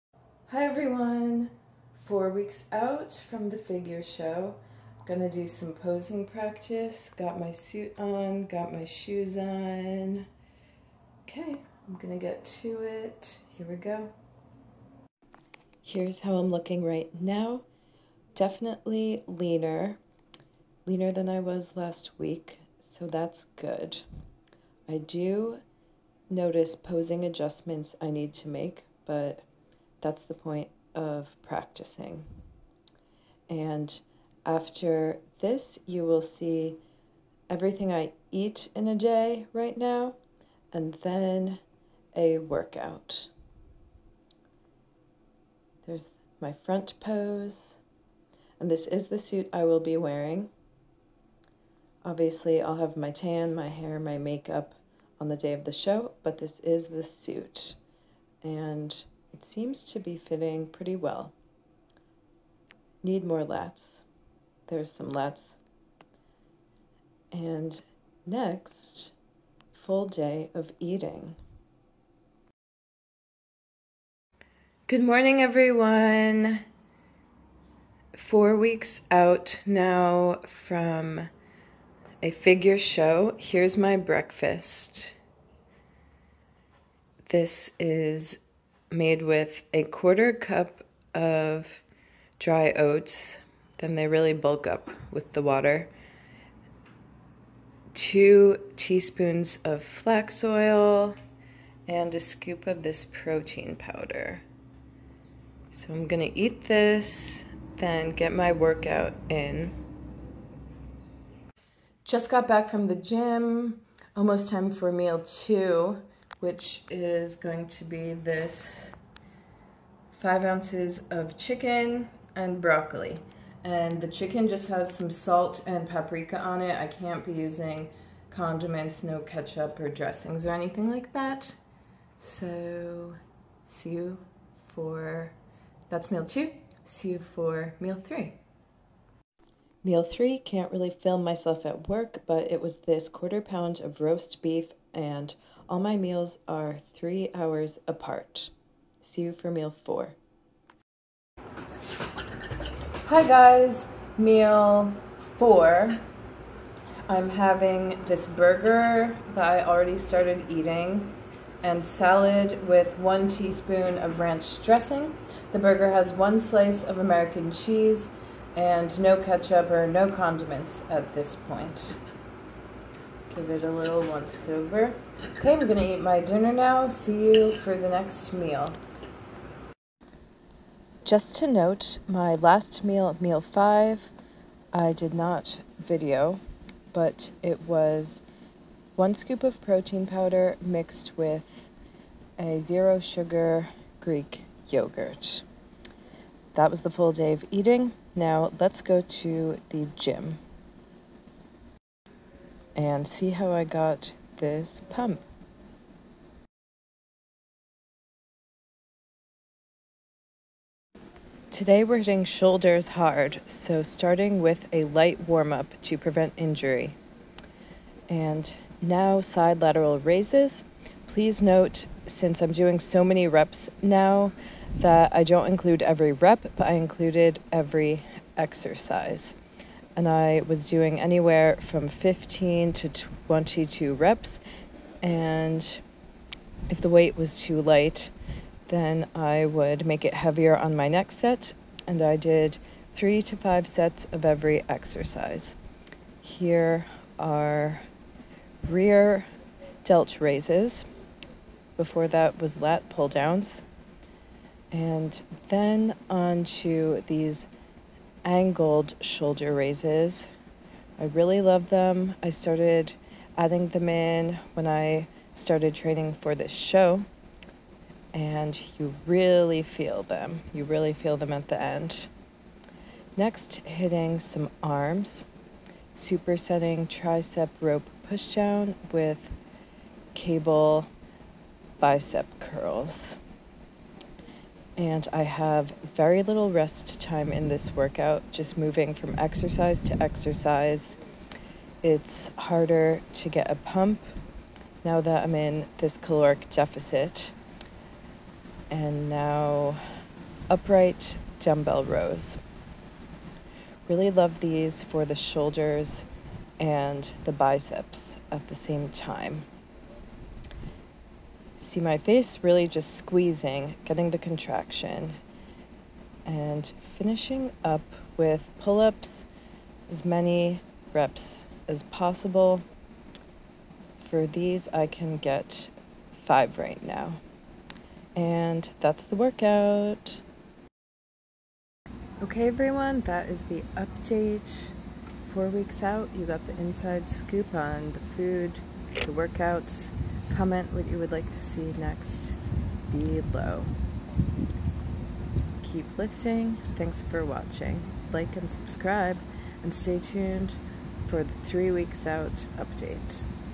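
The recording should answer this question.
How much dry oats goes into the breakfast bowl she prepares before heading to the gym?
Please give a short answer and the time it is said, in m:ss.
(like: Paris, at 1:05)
1/4 cup, at 1:29.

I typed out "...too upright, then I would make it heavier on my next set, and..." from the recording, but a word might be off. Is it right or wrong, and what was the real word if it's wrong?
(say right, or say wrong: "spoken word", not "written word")
wrong: "light", not "upright".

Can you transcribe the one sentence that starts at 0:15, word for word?
Here's how I'm looking right now.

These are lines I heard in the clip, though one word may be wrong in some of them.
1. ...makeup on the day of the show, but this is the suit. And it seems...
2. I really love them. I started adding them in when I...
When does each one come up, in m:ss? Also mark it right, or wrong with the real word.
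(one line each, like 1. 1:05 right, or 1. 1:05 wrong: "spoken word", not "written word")
1. 0:54 right
2. 4:20 right.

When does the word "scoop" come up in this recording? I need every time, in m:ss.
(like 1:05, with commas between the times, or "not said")
1:42, 3:09, 5:37.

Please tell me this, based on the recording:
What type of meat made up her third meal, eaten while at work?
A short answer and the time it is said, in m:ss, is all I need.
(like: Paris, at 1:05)
roast beef, at 2:24.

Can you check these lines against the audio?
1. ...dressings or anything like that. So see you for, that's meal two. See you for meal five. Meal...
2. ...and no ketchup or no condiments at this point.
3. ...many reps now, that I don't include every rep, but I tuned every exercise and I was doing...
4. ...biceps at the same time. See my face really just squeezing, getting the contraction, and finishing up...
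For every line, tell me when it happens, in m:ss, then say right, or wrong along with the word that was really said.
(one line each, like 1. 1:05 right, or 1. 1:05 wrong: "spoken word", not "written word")
1. 2:09 wrong: "three", not "five"
2. 2:48 right
3. 3:43 wrong: "included", not "tuned"
4. 5:07 right.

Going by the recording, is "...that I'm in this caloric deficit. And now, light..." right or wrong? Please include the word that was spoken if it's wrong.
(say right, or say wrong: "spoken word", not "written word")
wrong: "upright", not "light".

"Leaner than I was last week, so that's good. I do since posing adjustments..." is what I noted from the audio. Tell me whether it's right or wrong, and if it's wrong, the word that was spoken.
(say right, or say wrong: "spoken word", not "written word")
wrong: "notice", not "since".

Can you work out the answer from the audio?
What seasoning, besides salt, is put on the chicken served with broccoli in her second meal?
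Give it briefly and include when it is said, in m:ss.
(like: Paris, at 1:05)
paprika, at 2:05.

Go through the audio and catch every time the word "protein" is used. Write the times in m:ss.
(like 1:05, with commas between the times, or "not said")
1:43, 3:09.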